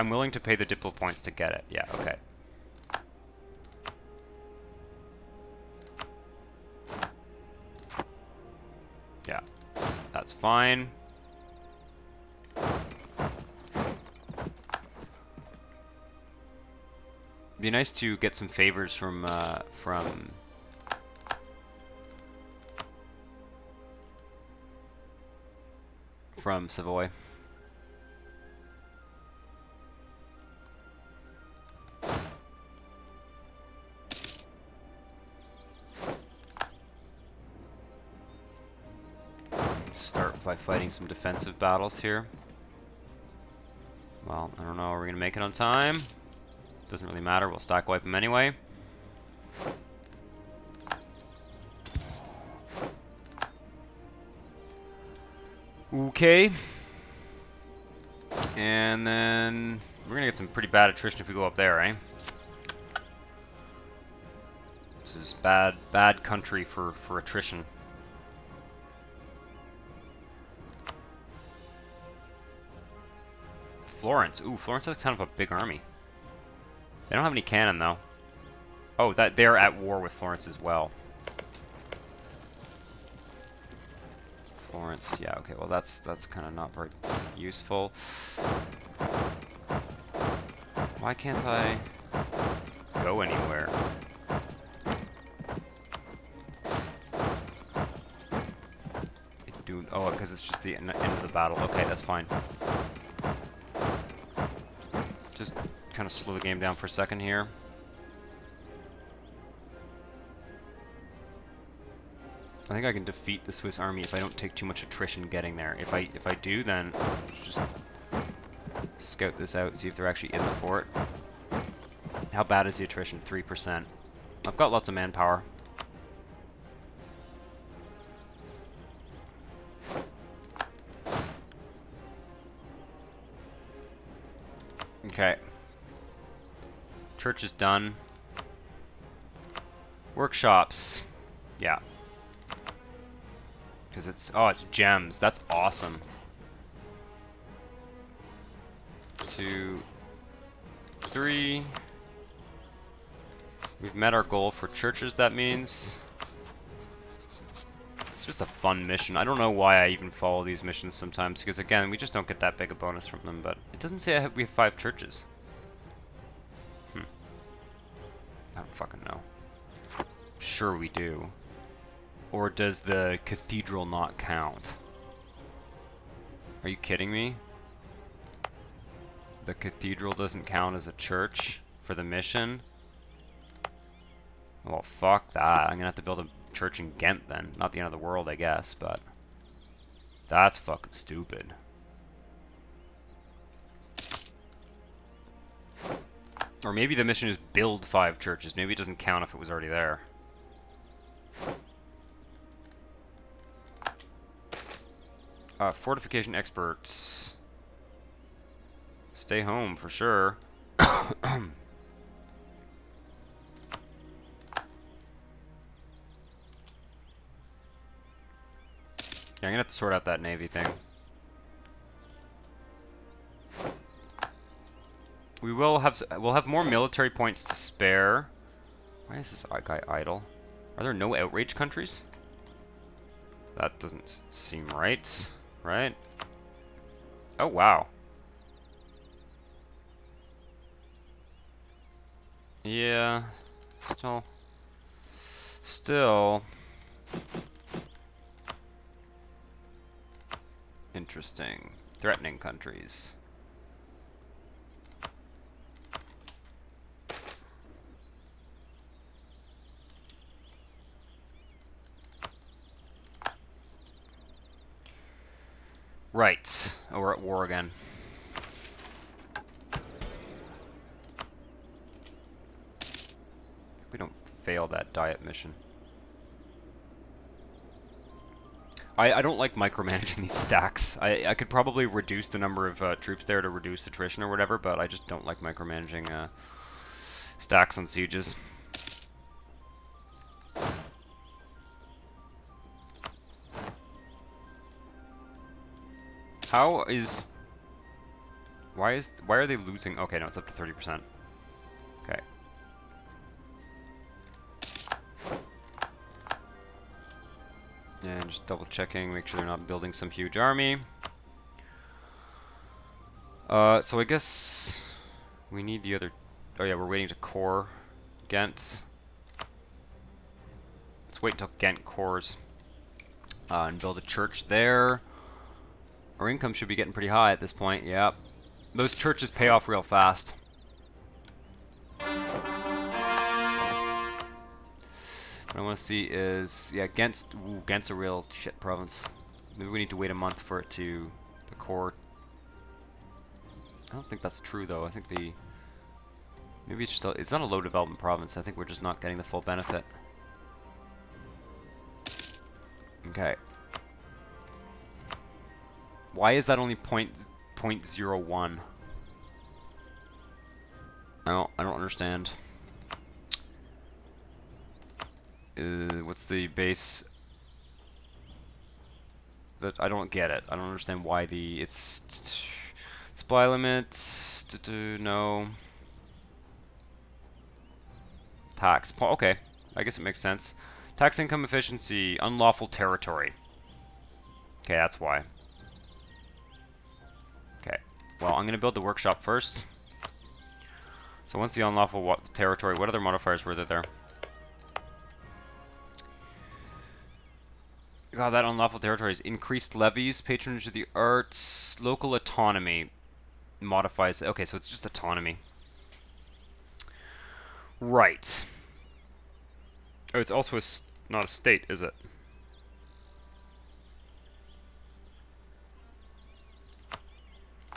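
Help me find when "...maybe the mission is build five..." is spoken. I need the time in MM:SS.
03:16.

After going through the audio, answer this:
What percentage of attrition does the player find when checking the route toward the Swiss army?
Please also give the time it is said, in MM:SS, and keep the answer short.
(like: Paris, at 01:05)
3%, at 02:03.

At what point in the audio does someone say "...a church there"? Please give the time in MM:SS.
05:23.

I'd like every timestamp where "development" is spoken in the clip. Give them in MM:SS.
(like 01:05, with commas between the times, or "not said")
05:47.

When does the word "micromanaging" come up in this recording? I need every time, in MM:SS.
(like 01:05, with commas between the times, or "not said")
04:39, 04:45.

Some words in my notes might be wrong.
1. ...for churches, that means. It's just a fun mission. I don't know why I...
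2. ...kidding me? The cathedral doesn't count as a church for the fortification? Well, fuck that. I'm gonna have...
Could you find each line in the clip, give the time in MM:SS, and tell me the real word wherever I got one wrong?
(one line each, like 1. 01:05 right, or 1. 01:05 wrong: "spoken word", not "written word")
1. 02:34 right
2. 02:56 wrong: "mission", not "fortification".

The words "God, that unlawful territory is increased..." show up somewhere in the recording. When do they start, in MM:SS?
06:38.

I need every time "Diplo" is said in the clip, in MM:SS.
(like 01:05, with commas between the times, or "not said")
00:00.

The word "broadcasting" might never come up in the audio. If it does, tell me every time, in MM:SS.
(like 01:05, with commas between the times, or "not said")
not said.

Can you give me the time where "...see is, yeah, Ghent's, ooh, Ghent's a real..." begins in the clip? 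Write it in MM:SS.
05:35.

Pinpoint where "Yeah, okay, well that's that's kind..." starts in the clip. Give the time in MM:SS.
01:25.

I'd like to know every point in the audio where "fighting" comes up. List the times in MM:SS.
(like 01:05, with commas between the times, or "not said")
00:40.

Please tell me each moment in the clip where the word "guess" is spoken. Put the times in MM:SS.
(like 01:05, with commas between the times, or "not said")
03:08, 05:14, 06:19.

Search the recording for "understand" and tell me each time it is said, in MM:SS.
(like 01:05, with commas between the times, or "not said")
06:01, 06:10.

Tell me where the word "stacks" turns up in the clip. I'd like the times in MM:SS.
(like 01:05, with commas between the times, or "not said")
00:47, 04:40, 04:47.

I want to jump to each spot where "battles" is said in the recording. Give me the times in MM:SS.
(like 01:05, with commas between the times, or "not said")
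00:41, 01:41.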